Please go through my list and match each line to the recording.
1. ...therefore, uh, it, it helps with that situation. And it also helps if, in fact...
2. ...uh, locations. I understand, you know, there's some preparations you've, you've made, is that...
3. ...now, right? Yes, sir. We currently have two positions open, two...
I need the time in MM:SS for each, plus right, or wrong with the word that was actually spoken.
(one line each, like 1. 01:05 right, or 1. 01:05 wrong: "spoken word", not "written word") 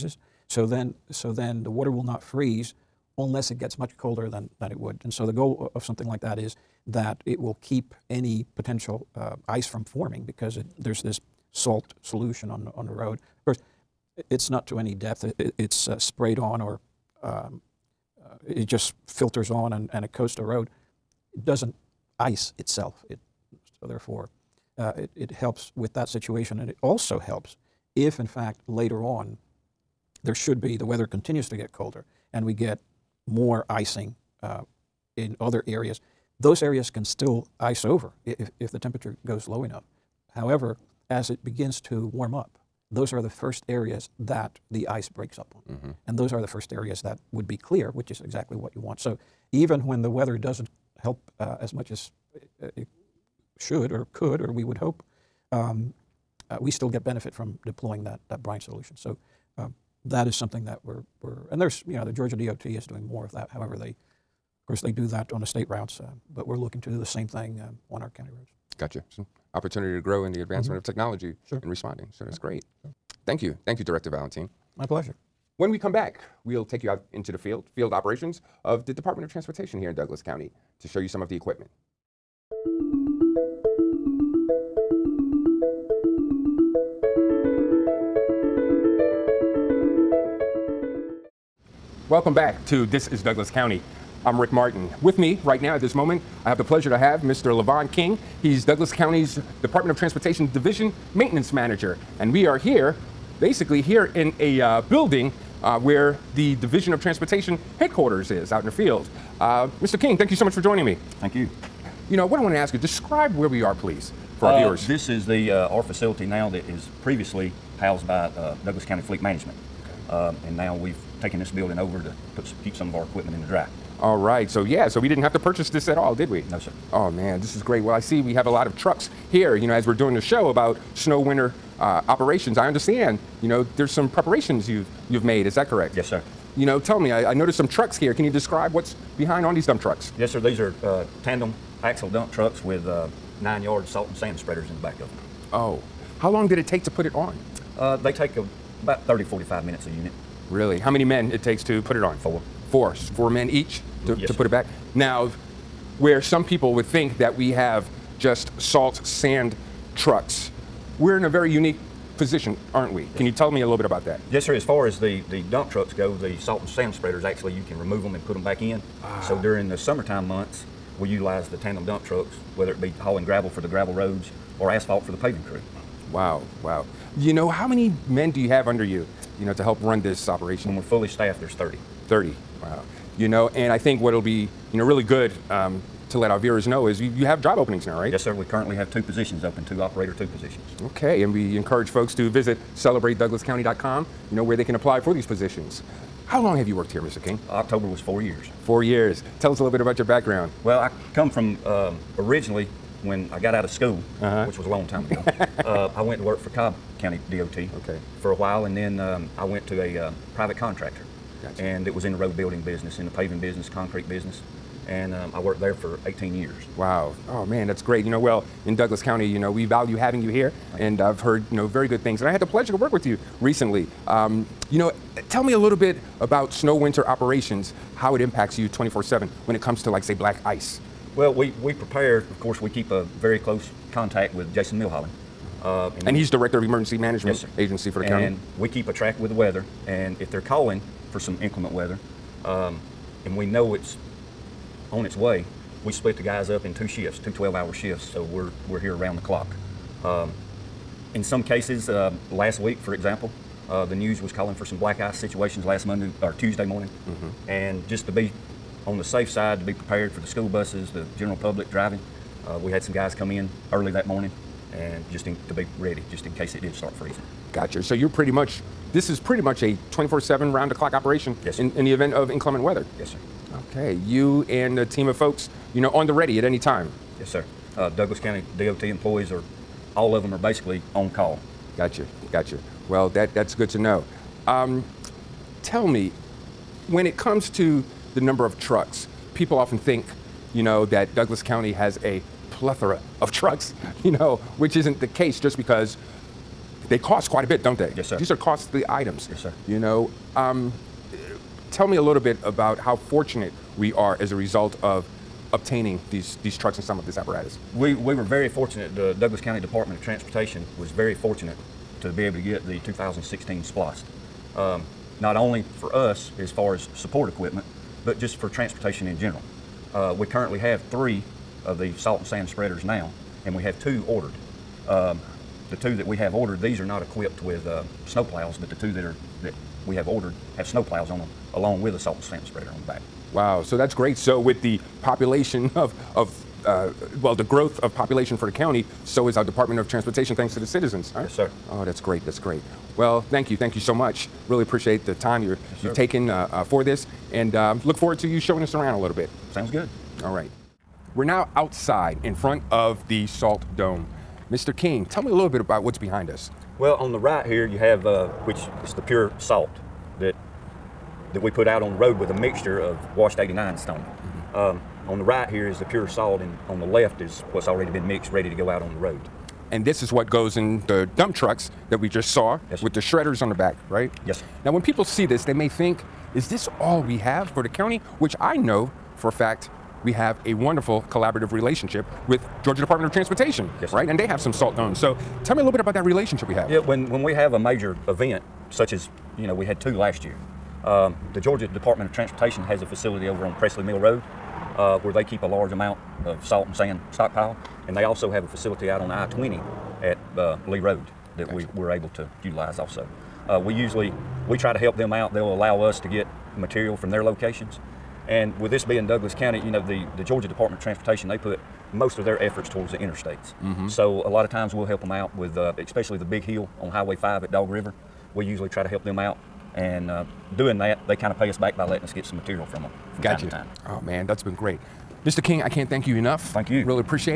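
1. 00:23 right
2. 02:11 wrong: "operations", not "locations"
3. 03:07 right.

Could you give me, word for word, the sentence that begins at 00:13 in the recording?
Of course, it's not to any depth.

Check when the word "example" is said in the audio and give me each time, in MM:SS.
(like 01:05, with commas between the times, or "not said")
04:12.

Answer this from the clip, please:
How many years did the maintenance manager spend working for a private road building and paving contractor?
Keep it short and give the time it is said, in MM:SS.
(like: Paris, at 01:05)
18, at 03:36.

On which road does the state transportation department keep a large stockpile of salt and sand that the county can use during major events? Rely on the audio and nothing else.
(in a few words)
Presley Mill Road.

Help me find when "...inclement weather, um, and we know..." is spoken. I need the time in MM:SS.
04:01.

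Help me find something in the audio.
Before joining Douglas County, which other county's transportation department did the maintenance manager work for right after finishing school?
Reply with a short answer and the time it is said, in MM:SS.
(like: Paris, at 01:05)
Cobb County, at 03:26.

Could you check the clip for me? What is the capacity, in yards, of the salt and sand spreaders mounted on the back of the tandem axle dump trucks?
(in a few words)
9 yards.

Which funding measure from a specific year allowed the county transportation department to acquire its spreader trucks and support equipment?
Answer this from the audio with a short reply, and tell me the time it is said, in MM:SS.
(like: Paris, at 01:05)
2016 SPLOST, at 05:12.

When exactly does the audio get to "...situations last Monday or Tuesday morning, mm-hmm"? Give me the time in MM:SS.
04:15.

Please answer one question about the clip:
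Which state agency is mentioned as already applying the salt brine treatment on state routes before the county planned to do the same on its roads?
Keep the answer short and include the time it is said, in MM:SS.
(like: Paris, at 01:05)
Georgia DOT, at 01:02.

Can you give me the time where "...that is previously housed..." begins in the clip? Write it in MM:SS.
01:56.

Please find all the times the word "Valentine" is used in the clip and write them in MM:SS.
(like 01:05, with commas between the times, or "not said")
01:14.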